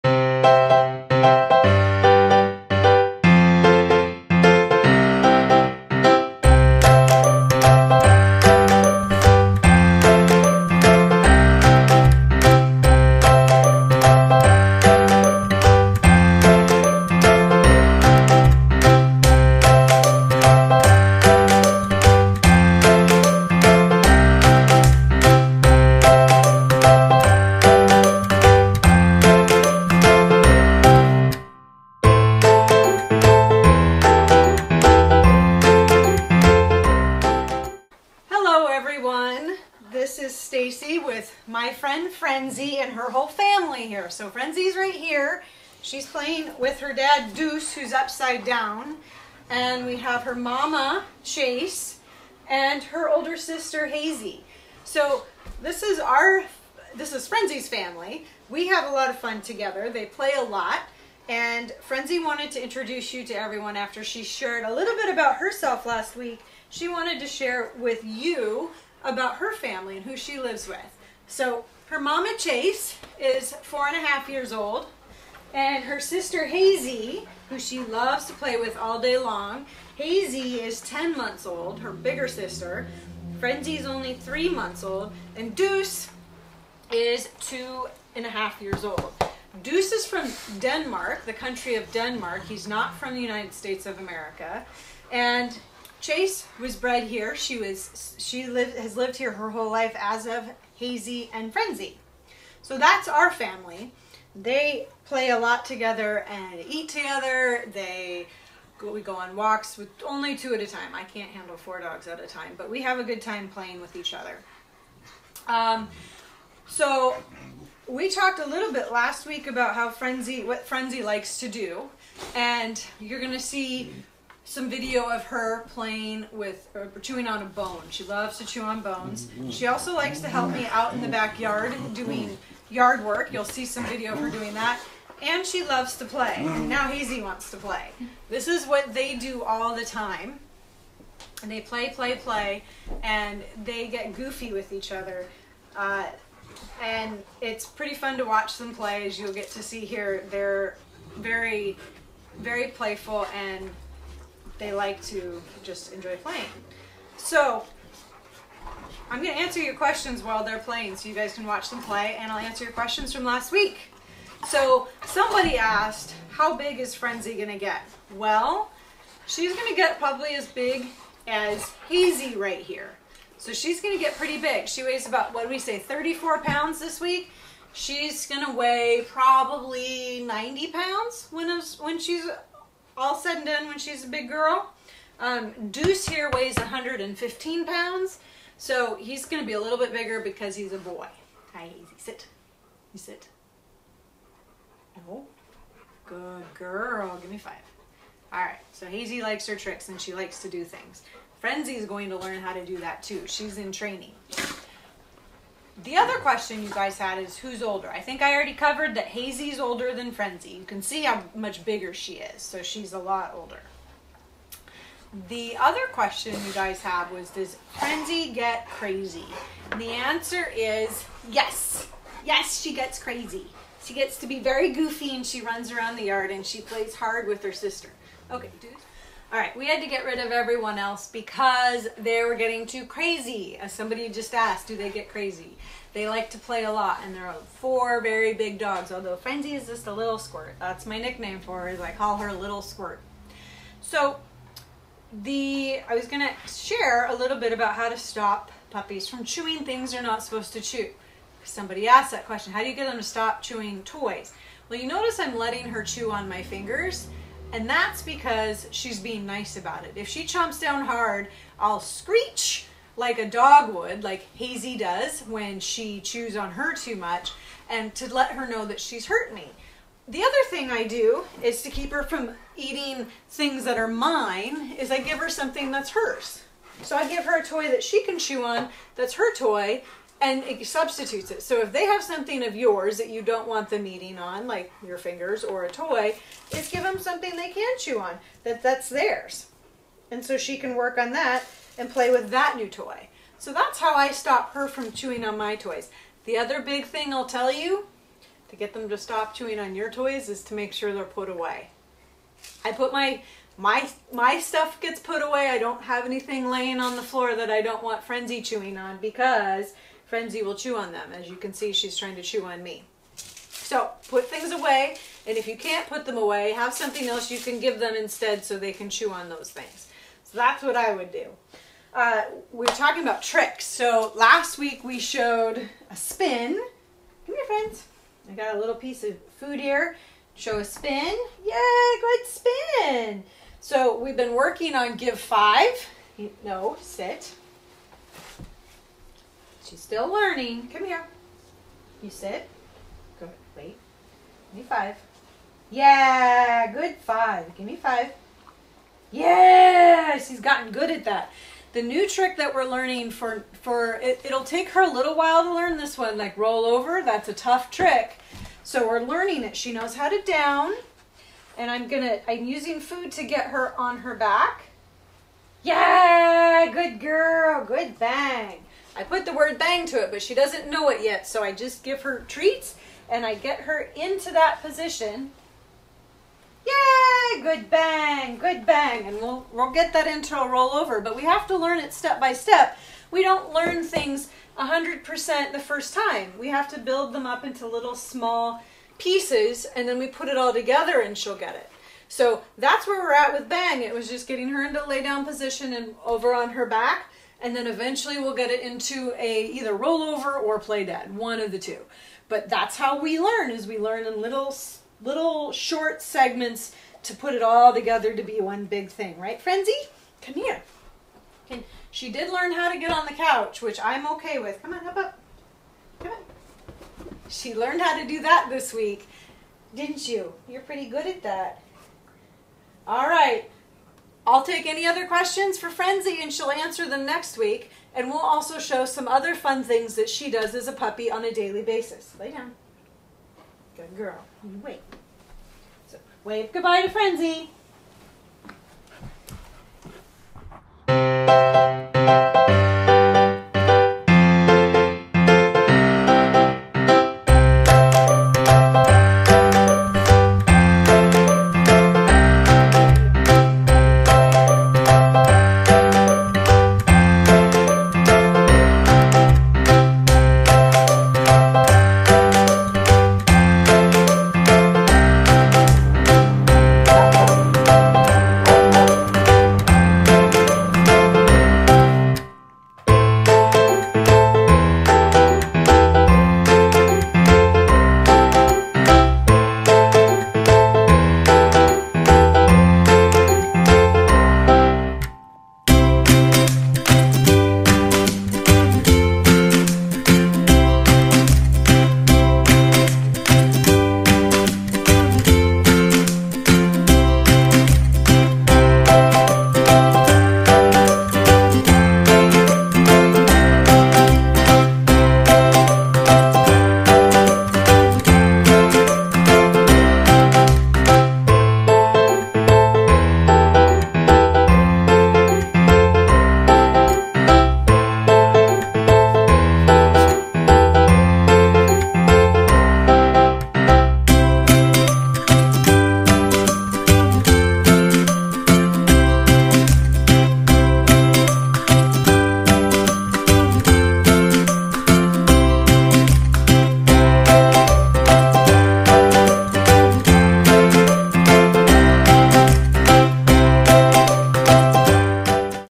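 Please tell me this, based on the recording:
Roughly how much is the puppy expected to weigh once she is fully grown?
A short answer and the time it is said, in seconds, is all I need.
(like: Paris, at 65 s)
90 pounds, at 180 s.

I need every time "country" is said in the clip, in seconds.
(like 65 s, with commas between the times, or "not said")
91 s.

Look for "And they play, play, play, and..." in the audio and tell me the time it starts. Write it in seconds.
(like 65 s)
141 s.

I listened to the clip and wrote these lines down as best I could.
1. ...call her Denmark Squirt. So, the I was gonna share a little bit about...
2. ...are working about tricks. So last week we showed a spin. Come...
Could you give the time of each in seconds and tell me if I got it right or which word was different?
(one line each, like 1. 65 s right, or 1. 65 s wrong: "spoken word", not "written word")
1. 241 s wrong: "Little", not "Denmark"
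2. 322 s wrong: "talking", not "working".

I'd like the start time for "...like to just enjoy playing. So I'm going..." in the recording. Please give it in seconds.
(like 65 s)
154 s.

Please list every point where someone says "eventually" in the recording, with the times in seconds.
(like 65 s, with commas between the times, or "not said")
397 s.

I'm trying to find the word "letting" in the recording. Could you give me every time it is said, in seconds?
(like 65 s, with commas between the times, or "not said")
255 s.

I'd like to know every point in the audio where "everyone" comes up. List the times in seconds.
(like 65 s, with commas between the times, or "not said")
63 s, 230 s.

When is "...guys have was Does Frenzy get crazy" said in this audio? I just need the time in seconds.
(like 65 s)
216 s.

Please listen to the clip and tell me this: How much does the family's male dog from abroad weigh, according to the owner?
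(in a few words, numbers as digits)
115 pounds.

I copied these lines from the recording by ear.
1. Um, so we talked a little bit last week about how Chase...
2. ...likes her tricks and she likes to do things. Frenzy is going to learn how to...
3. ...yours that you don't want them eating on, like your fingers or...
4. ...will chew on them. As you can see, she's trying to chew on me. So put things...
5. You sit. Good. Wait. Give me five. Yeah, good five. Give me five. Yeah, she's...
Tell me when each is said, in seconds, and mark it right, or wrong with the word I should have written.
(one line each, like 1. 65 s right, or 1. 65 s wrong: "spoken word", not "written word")
1. 115 s wrong: "Frenzy", not "Chase"
2. 199 s right
3. 282 s right
4. 310 s right
5. 342 s right.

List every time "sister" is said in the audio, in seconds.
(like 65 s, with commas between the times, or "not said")
53 s, 75 s, 82 s, 227 s.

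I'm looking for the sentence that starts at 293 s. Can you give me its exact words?
So that's how I stop her from chewing on my toys.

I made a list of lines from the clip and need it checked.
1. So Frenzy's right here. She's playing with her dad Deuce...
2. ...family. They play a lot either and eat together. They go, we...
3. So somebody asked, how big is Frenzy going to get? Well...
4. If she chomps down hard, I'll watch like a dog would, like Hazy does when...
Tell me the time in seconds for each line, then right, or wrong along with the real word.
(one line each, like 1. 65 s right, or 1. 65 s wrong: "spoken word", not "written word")
1. 44 s right
2. 103 s wrong: "together", not "either"
3. 164 s right
4. 259 s wrong: "screech", not "watch".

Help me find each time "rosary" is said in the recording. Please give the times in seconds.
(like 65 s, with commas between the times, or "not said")
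not said.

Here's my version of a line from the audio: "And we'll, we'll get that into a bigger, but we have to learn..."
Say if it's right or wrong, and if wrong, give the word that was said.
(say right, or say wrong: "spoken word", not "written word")
wrong: "rollover", not "bigger".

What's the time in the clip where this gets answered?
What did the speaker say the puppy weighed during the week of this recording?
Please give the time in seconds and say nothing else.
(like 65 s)
175 s.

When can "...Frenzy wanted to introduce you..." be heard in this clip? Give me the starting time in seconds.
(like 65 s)
61 s.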